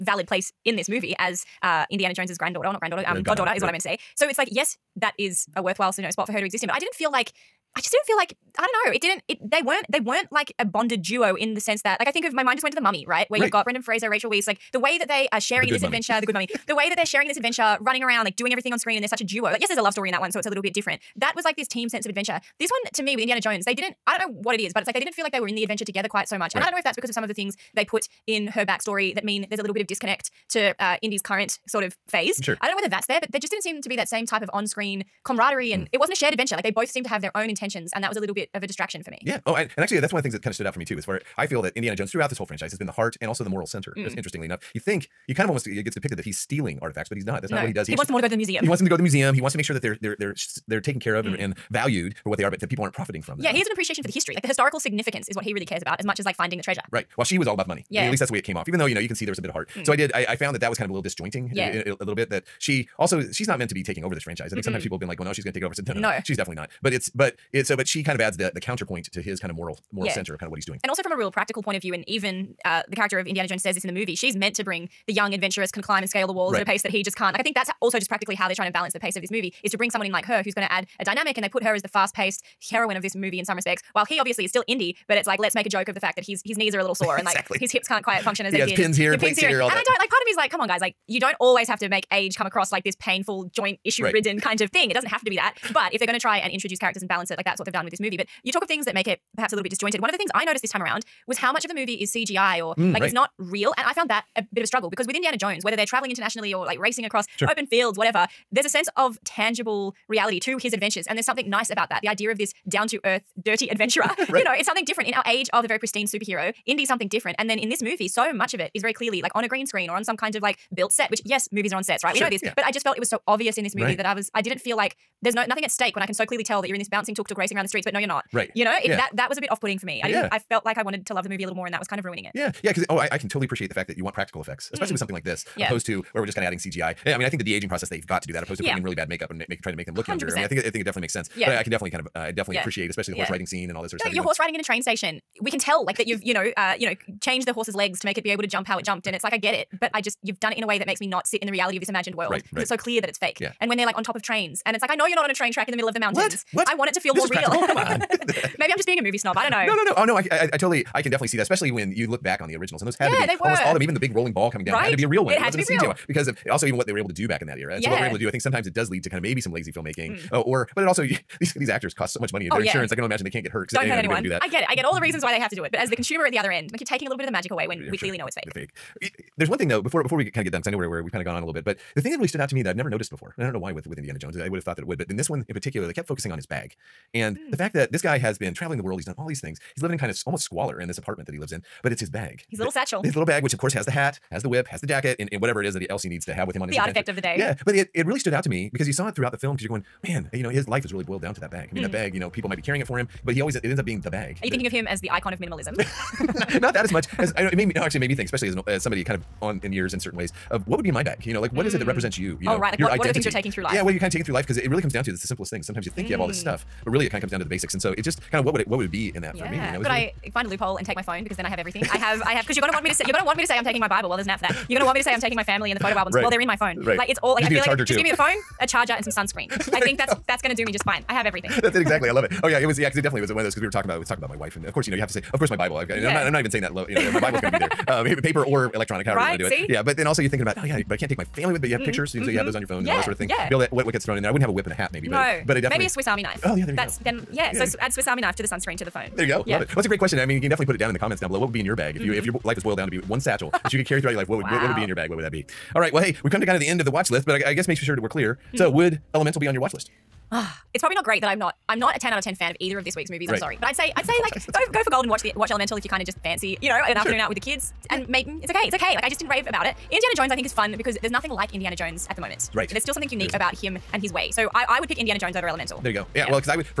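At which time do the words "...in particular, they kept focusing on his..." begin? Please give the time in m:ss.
3:05.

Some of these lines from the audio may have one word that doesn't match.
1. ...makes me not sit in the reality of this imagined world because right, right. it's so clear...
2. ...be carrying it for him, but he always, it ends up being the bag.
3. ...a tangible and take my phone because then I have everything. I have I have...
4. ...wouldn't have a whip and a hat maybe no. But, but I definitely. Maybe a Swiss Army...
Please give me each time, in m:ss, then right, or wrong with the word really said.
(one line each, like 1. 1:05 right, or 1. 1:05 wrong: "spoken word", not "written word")
1. 2:30 right
2. 3:22 right
3. 3:40 wrong: "loophole", not "tangible"
4. 4:04 right.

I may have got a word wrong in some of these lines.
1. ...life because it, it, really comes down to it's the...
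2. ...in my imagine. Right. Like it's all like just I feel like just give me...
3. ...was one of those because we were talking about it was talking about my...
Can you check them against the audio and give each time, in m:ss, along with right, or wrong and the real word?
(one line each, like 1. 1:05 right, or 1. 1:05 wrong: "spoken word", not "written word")
1. 3:34 right
2. 3:46 wrong: "phone", not "imagine"
3. 3:53 right.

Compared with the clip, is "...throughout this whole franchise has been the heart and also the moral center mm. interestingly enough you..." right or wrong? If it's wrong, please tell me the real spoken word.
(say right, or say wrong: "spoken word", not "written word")
right.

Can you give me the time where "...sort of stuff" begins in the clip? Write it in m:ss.
2:23.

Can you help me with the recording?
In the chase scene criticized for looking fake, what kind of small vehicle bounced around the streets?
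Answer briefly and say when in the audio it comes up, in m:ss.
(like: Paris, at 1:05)
Tuk tuk, at 2:07.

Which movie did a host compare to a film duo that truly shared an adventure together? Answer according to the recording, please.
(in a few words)
The Mummy.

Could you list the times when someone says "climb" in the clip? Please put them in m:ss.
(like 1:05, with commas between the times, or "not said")
1:15.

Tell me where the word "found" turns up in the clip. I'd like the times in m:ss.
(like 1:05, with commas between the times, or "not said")
1:00, 1:43.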